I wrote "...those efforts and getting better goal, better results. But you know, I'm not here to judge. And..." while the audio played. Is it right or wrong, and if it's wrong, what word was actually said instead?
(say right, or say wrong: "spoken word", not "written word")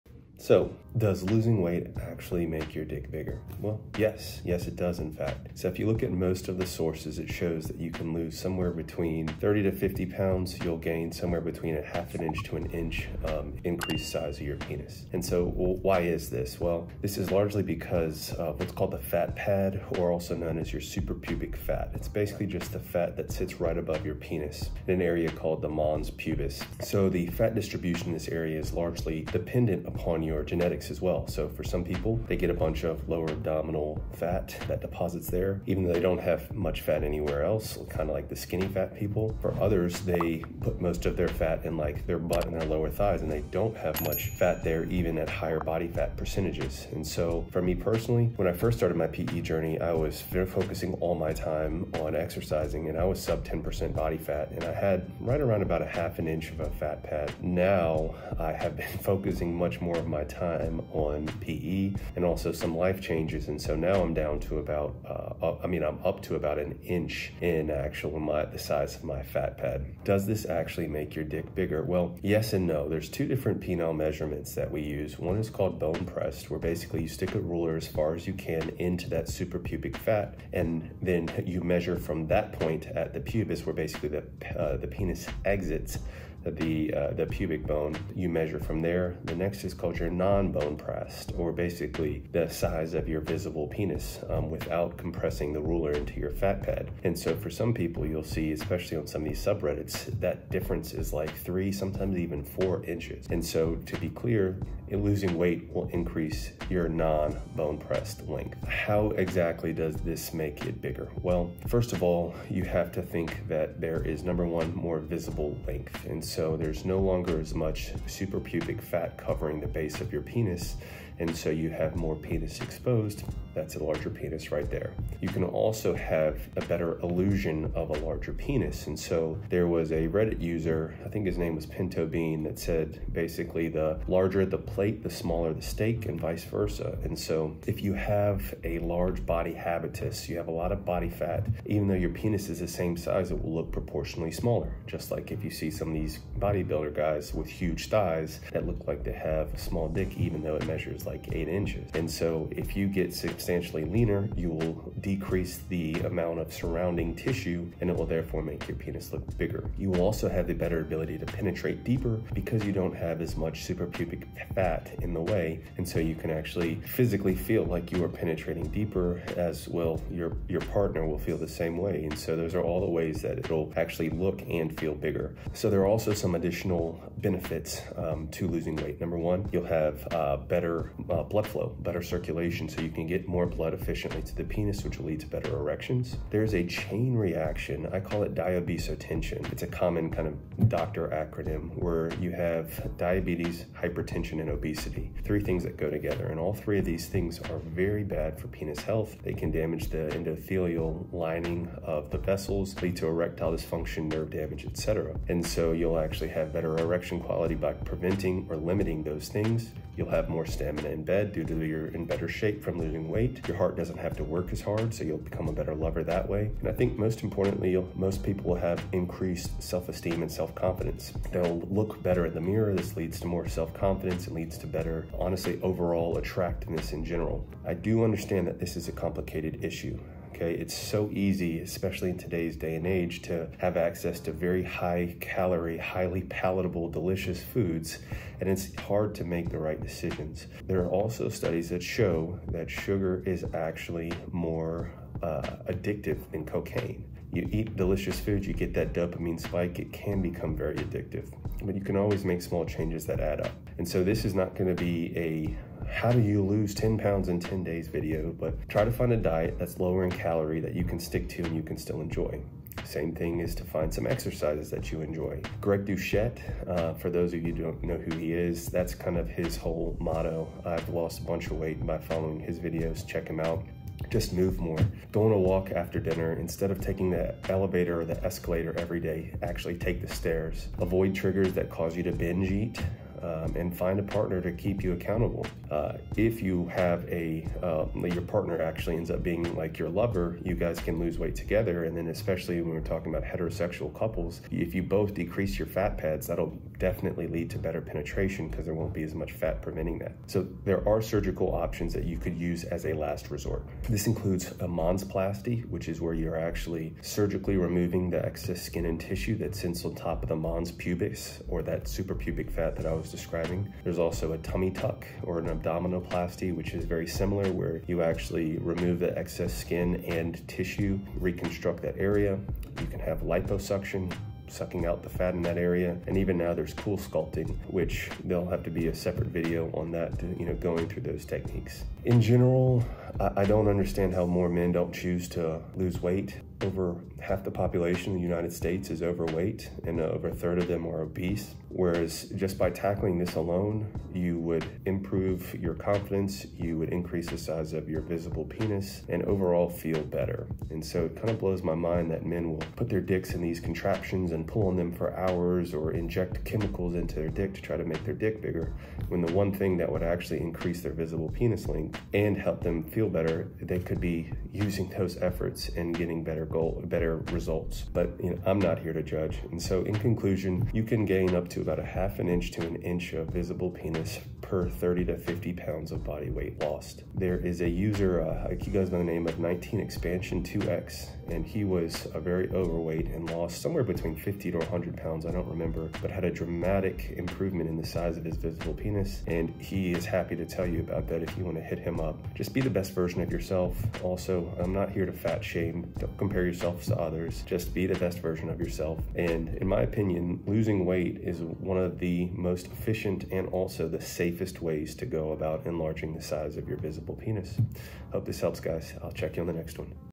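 right.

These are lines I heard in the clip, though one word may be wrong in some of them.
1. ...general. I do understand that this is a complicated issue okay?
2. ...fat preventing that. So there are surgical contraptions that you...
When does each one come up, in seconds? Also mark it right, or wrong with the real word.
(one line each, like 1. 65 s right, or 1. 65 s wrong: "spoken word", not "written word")
1. 227 s right
2. 299 s wrong: "options", not "contraptions".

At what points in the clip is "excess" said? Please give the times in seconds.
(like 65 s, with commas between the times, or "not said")
308 s, 319 s.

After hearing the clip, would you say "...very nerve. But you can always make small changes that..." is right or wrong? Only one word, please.
wrong.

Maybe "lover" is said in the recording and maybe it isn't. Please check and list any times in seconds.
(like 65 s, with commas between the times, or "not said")
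215 s, 289 s.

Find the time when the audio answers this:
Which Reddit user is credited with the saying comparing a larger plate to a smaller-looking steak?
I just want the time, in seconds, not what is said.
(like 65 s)
131 s.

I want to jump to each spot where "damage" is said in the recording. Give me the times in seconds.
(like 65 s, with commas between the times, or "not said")
199 s, 204 s.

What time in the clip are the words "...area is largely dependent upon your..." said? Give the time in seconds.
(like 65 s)
28 s.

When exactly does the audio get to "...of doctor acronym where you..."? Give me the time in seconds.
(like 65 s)
190 s.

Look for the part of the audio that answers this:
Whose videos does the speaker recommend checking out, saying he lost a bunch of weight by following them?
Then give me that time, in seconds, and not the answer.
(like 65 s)
265 s.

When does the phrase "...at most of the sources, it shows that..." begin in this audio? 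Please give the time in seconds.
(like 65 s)
6 s.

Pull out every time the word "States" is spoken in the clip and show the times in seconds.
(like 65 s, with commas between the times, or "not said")
338 s.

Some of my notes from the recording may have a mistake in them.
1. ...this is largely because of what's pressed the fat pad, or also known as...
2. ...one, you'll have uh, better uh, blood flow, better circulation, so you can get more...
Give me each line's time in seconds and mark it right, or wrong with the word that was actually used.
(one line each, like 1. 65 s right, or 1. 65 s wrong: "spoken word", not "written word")
1. 17 s wrong: "called", not "pressed"
2. 179 s right.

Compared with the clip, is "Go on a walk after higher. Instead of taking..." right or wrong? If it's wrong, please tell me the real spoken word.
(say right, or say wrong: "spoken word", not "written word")
wrong: "dinner", not "higher".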